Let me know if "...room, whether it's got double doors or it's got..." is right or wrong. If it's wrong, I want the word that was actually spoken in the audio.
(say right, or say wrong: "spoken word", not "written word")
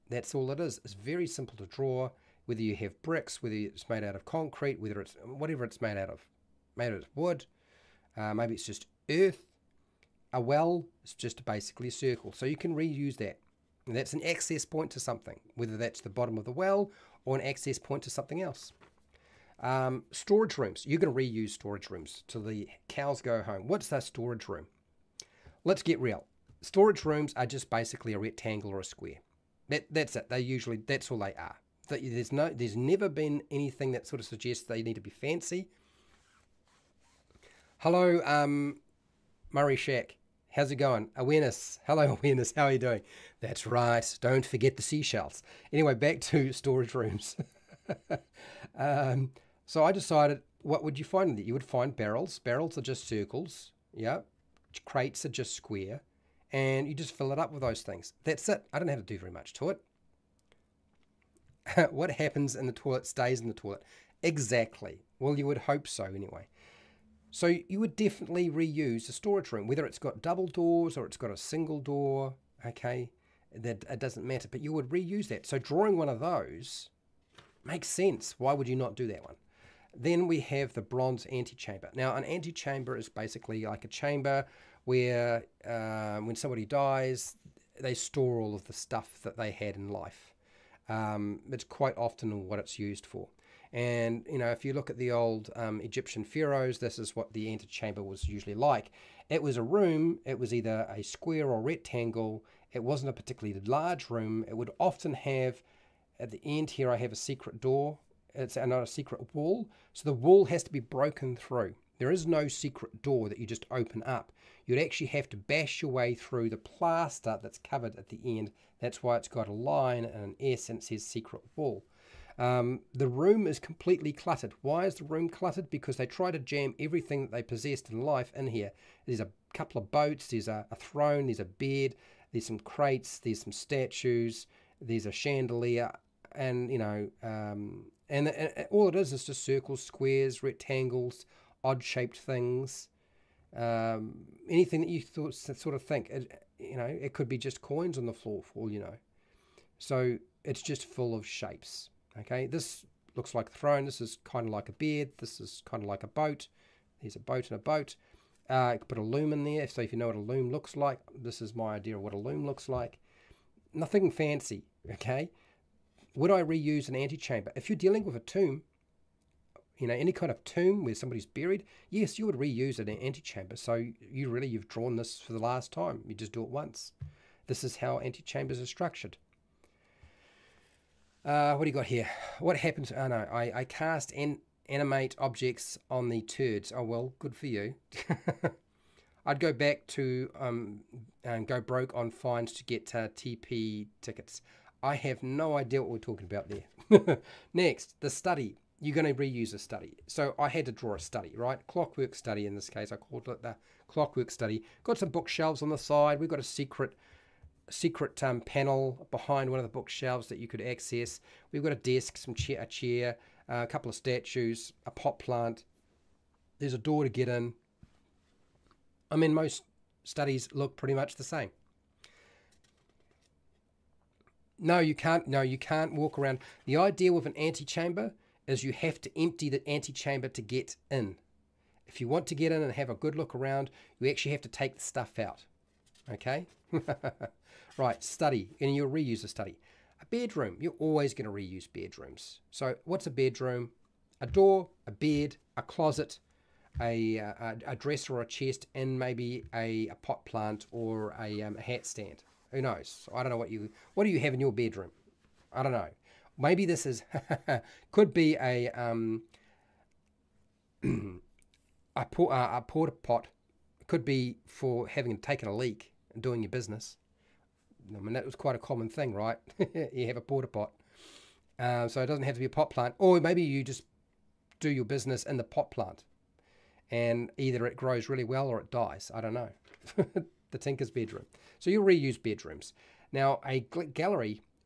right.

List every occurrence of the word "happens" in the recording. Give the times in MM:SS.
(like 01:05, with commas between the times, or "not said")
01:02, 03:02.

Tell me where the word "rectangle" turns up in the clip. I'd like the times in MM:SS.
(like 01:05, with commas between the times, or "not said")
00:28, 01:41, 02:20.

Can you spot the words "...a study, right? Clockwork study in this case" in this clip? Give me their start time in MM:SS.
03:20.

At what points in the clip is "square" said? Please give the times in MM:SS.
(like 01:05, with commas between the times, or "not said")
00:28, 00:55, 01:41, 02:19.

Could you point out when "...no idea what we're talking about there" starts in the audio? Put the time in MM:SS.
03:15.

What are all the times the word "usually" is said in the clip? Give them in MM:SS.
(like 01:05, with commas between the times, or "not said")
00:30, 01:38.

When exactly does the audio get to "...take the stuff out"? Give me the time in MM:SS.
03:54.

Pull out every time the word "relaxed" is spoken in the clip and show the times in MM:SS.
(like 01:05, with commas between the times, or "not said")
not said.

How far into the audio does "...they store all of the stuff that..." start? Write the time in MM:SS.
01:27.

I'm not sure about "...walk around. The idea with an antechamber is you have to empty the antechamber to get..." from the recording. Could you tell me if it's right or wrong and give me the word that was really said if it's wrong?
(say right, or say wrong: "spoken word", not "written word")
right.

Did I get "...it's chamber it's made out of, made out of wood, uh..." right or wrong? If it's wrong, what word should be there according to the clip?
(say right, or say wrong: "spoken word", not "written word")
wrong: "whatever", not "chamber".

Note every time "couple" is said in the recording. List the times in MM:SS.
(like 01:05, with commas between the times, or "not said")
02:09, 03:33.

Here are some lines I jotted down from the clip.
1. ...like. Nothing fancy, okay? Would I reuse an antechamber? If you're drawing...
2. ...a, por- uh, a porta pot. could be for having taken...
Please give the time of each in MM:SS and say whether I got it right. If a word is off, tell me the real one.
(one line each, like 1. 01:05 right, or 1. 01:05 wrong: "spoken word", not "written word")
1. 02:42 wrong: "dealing", not "drawing"
2. 04:21 right.